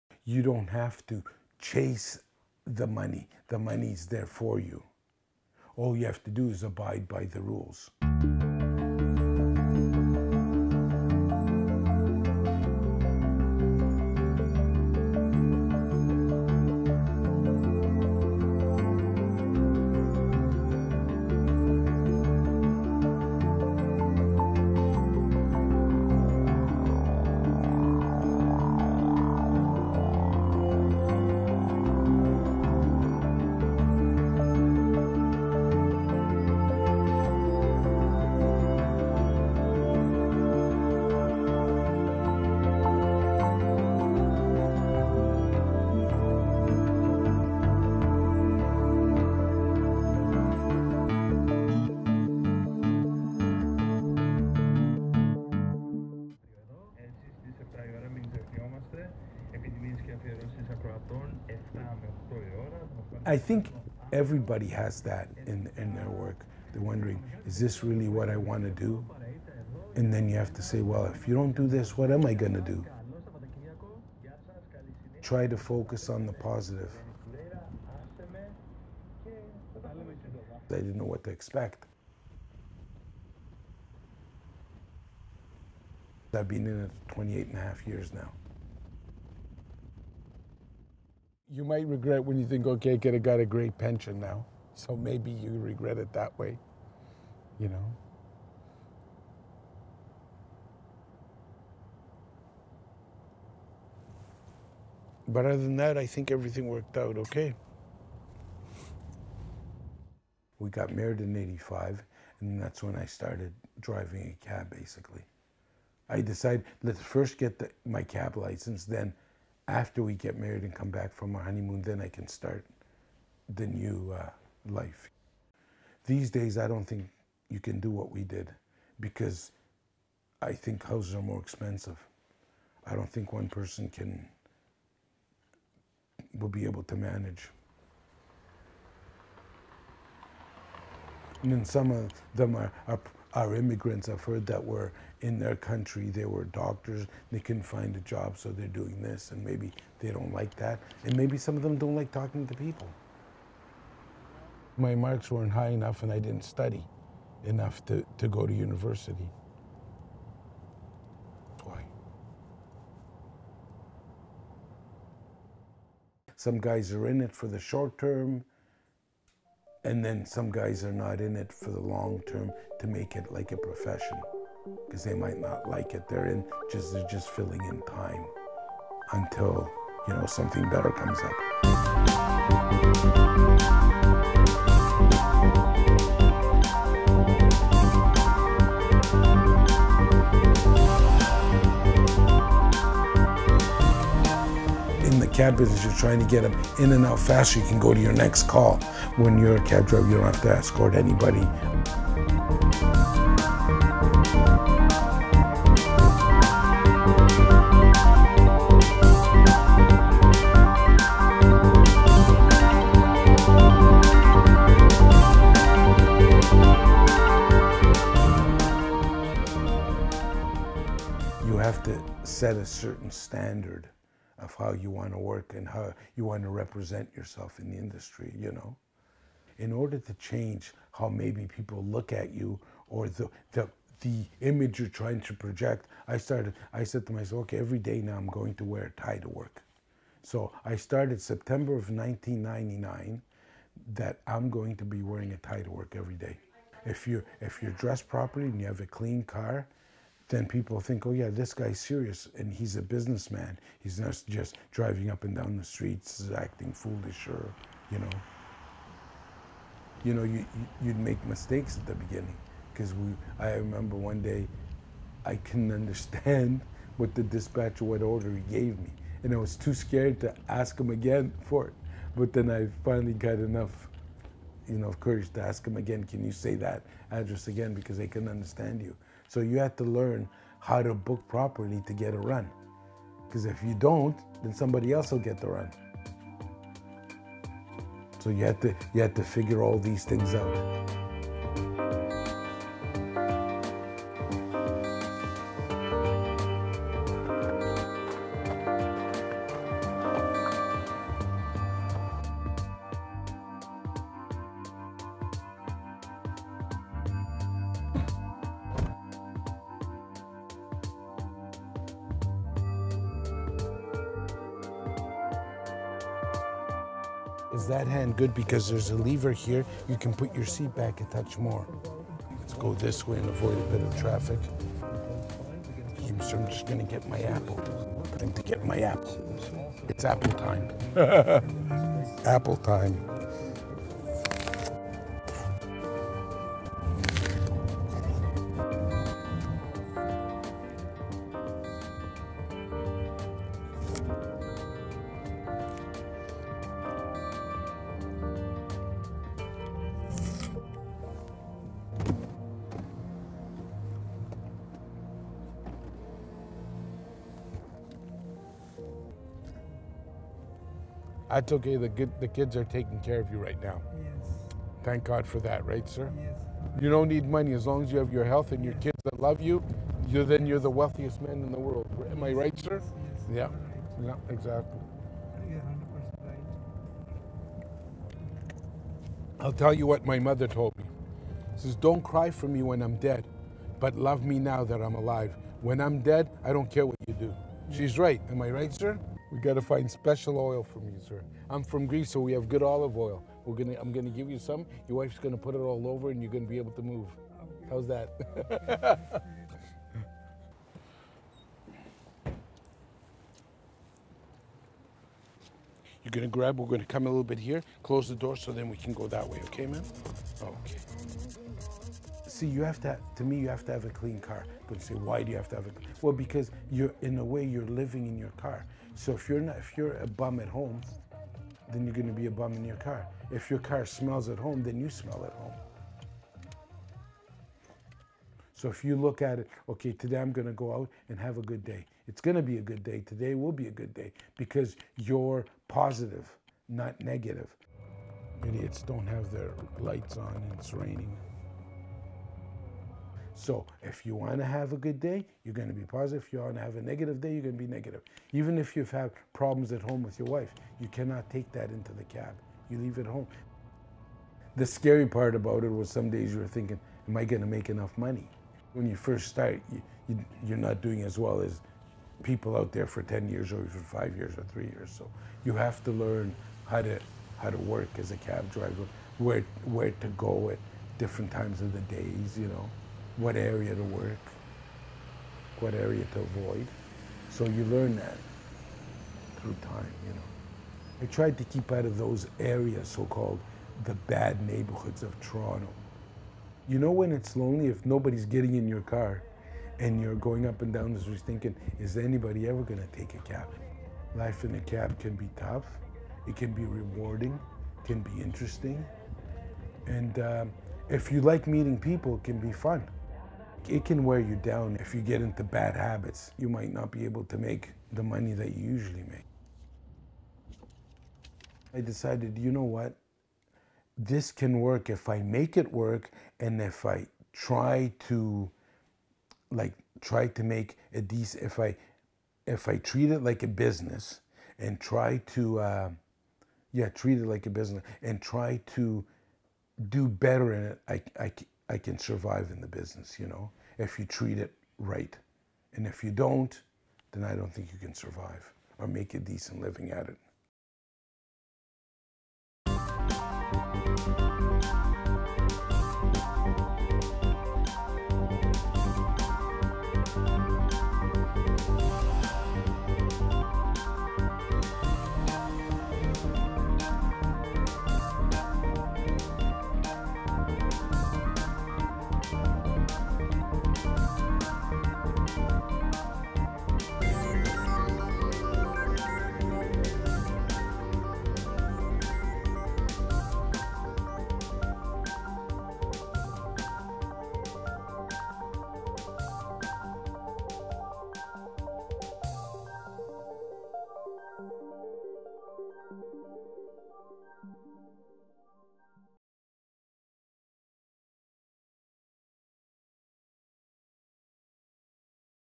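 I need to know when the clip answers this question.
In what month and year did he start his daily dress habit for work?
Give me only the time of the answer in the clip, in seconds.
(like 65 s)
241 s.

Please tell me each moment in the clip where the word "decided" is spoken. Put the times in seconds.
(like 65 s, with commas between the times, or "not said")
116 s, 511 s.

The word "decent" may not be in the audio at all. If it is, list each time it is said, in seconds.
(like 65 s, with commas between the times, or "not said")
521 s, 539 s.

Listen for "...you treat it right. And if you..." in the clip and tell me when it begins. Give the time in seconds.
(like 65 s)
533 s.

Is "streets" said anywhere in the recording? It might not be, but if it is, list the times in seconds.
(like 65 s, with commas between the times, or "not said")
255 s, 490 s.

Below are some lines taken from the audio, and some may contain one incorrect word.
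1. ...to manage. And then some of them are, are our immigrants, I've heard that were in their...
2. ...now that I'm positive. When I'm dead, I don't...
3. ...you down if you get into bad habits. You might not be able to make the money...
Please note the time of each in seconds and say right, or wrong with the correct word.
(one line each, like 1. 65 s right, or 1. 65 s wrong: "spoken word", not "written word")
1. 136 s right
2. 384 s wrong: "alive", not "positive"
3. 504 s right.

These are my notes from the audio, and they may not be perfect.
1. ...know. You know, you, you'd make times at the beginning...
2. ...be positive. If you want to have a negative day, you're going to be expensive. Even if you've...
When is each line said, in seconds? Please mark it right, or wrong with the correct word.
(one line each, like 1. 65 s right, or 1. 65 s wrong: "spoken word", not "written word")
1. 257 s wrong: "mistakes", not "times"
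2. 445 s wrong: "negative", not "expensive".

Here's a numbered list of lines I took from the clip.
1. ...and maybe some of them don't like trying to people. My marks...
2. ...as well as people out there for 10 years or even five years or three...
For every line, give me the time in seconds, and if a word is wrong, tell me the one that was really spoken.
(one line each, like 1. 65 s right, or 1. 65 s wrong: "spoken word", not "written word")
1. 151 s wrong: "talking", not "trying"
2. 461 s right.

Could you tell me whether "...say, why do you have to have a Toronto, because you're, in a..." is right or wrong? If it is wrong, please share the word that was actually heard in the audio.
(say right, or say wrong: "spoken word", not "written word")
wrong: "Well", not "Toronto".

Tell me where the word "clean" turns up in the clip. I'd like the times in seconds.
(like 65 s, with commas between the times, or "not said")
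248 s, 413 s.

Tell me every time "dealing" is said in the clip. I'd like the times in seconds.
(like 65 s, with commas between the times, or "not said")
not said.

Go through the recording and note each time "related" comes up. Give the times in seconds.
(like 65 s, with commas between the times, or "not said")
not said.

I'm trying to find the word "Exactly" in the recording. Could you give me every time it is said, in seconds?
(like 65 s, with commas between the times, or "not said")
374 s.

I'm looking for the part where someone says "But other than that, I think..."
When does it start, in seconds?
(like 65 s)
105 s.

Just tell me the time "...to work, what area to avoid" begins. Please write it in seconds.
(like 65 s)
473 s.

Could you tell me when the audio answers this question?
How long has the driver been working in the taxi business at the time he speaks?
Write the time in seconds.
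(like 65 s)
87 s.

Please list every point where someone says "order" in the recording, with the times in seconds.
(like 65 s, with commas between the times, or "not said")
229 s, 268 s.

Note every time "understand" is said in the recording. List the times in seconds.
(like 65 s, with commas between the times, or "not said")
265 s, 278 s.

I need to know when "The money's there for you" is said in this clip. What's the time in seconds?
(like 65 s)
3 s.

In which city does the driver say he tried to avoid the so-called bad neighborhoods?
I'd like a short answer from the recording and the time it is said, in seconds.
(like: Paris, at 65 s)
Toronto, at 485 s.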